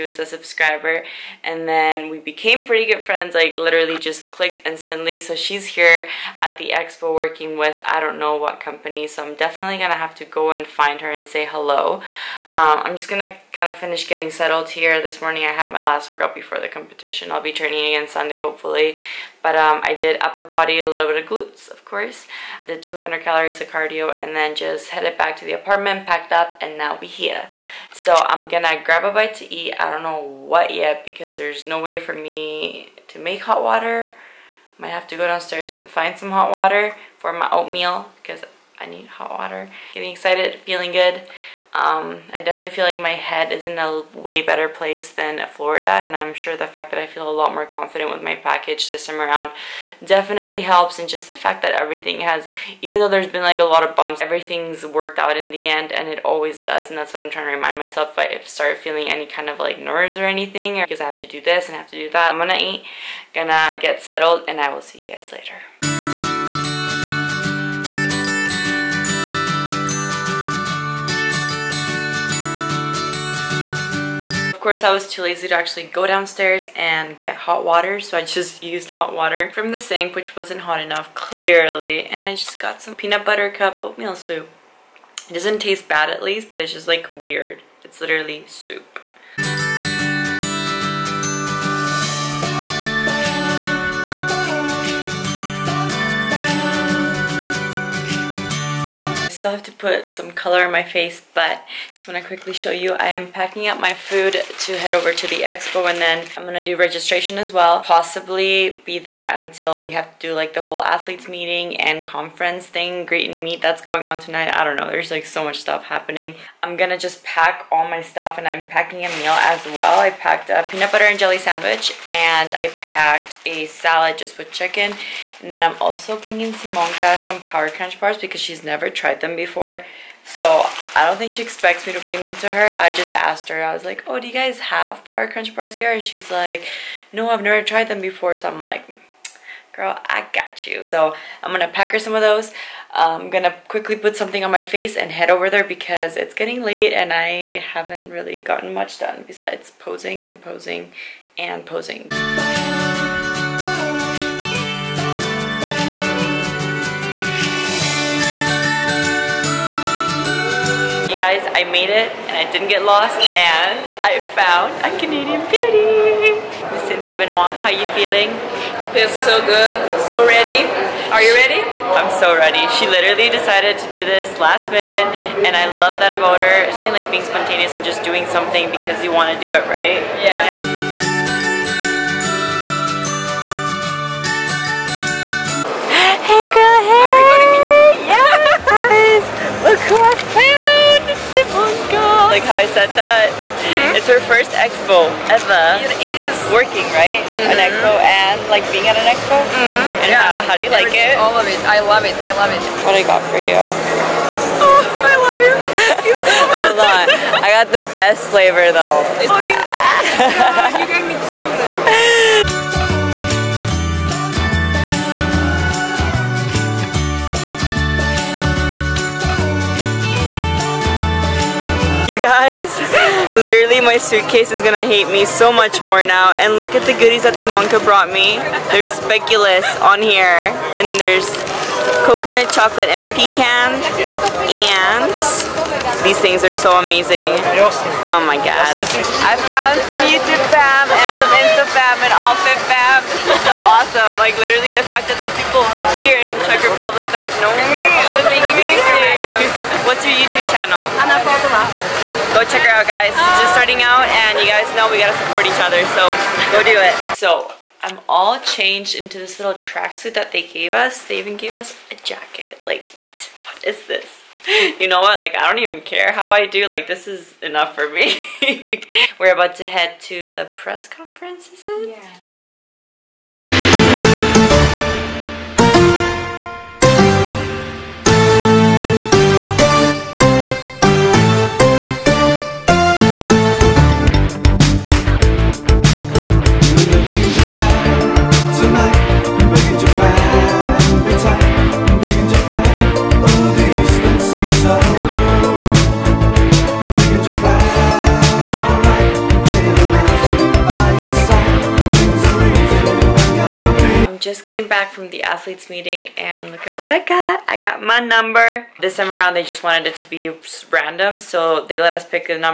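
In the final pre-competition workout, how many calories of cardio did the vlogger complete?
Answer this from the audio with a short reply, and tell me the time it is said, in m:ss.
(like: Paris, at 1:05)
200, at 0:22.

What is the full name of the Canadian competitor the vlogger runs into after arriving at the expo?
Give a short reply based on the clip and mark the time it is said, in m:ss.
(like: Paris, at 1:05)
Cynthia Benoit, at 2:46.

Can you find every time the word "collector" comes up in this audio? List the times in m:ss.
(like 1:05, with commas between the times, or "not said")
not said.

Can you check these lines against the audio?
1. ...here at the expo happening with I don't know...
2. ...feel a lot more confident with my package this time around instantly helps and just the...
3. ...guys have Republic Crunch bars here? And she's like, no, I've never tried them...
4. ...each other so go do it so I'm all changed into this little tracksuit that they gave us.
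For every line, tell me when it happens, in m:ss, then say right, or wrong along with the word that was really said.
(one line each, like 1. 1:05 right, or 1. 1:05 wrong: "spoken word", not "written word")
1. 0:05 wrong: "working", not "happening"
2. 0:47 wrong: "definitely", not "instantly"
3. 2:14 wrong: "Power", not "Republic"
4. 4:15 right.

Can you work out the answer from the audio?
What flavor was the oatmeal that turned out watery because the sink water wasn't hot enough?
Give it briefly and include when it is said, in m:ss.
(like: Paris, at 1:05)
Peanut butter cup, at 1:22.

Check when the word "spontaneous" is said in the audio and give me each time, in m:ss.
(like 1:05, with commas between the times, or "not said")
2:57.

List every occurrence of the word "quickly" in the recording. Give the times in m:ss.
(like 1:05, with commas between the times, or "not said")
1:42, 2:23.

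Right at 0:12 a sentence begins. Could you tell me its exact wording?
Um, I'm just gonna kind of finish getting settled here.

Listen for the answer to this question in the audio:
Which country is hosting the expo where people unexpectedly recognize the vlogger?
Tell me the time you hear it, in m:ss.
4:06.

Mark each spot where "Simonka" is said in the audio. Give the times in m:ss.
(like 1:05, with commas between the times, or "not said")
2:06, 3:47.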